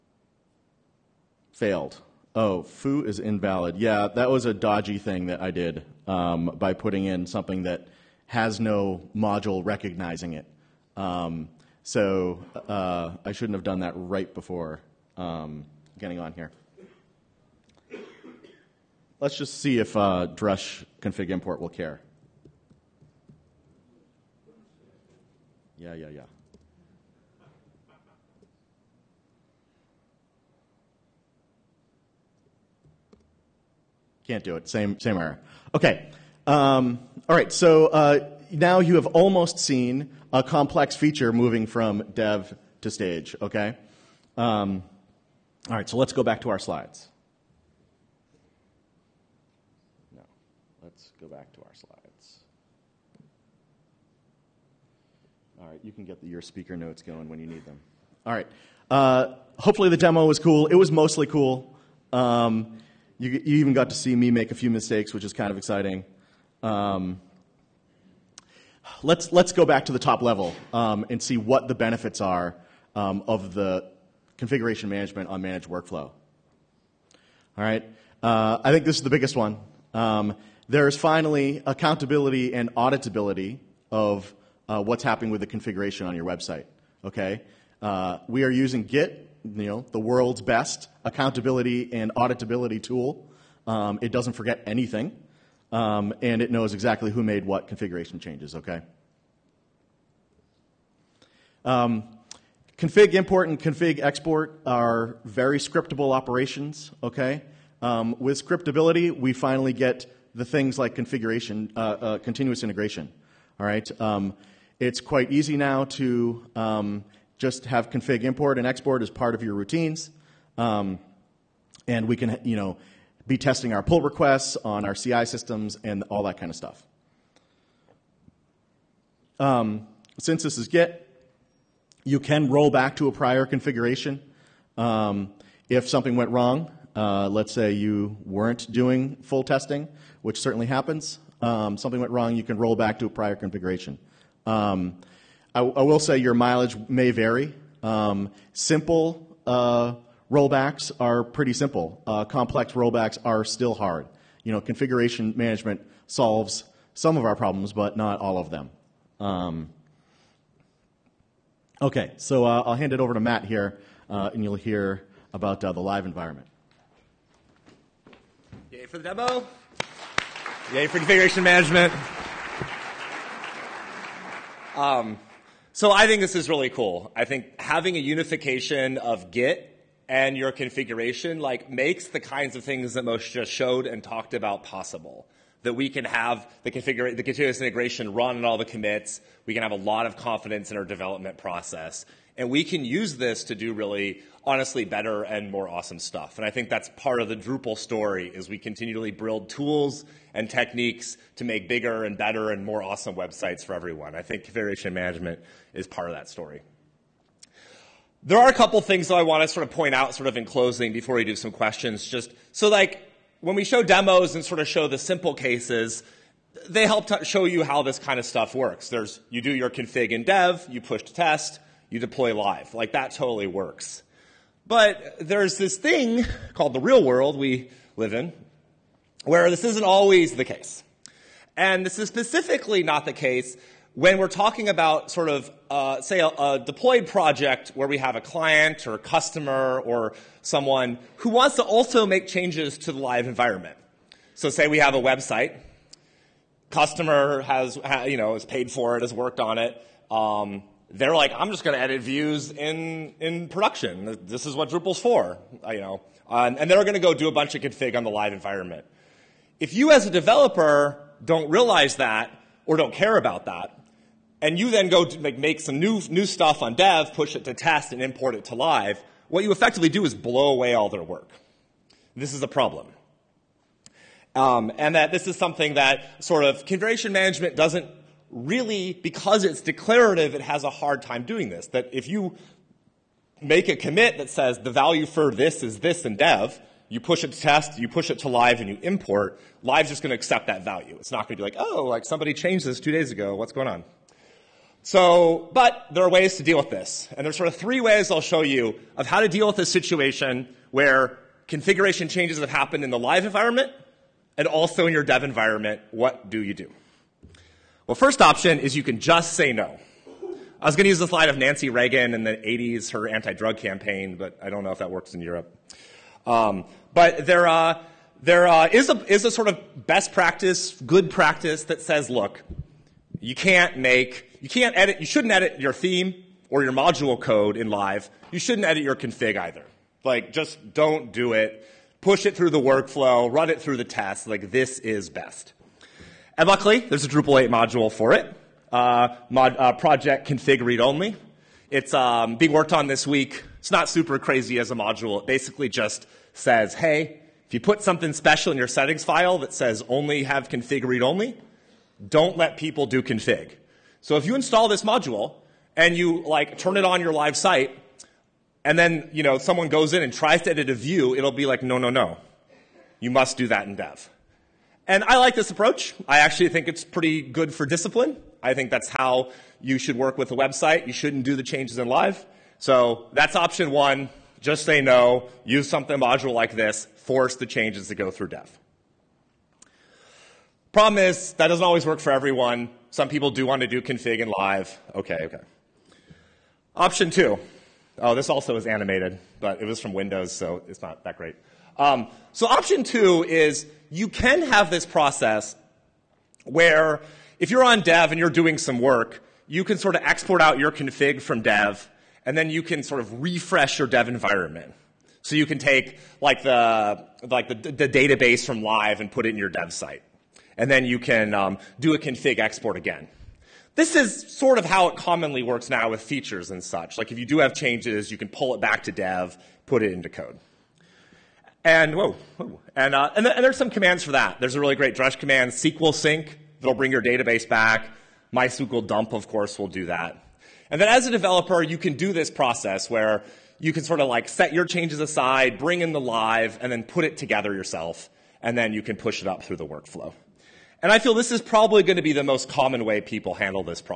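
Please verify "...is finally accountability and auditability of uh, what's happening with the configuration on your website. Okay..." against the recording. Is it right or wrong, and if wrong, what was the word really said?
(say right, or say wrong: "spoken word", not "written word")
right.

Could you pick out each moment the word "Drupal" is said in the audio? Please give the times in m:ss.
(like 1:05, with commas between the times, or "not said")
3:17, 4:14, 5:37.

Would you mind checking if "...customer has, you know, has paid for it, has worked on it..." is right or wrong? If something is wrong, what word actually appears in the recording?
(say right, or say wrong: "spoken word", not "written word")
right.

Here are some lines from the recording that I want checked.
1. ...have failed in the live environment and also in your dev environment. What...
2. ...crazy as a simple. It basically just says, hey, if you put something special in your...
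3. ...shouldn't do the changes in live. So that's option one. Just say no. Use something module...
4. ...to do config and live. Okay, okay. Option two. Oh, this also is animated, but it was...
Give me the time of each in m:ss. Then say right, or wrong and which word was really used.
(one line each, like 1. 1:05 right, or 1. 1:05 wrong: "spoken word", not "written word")
1. 5:02 wrong: "happened", not "failed"
2. 5:44 wrong: "module", not "simple"
3. 6:10 right
4. 6:23 right.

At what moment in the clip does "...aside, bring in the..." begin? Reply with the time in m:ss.
7:15.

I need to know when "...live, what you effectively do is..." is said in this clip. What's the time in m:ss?
4:28.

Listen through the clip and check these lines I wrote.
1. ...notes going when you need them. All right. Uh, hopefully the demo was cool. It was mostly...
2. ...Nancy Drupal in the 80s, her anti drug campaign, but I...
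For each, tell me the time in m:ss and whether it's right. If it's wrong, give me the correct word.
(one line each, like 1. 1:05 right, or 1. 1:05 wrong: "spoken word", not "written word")
1. 0:56 right
2. 5:11 wrong: "Reagan", not "Drupal".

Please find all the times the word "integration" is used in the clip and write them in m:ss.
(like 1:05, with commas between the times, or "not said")
1:52, 3:07.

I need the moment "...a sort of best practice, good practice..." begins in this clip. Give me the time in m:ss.
5:19.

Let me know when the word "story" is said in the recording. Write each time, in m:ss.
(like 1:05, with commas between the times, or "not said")
3:17, 3:26.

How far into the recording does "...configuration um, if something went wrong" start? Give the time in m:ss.
2:13.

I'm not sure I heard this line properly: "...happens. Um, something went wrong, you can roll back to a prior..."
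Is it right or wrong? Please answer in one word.
right.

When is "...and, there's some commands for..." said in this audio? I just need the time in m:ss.
7:03.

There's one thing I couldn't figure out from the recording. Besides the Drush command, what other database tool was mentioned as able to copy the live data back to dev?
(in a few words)
MySQL dump.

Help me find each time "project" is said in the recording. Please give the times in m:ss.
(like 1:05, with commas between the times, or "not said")
3:57, 5:39.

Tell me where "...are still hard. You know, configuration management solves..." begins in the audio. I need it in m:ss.
2:33.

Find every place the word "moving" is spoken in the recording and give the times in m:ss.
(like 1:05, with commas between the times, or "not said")
0:41.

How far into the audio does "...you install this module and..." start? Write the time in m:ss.
5:54.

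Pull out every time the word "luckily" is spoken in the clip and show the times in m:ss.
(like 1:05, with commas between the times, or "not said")
5:36.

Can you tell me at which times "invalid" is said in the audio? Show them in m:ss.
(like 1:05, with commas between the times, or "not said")
0:03.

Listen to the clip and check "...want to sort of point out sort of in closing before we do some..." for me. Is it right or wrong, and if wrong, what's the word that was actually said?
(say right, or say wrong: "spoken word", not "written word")
right.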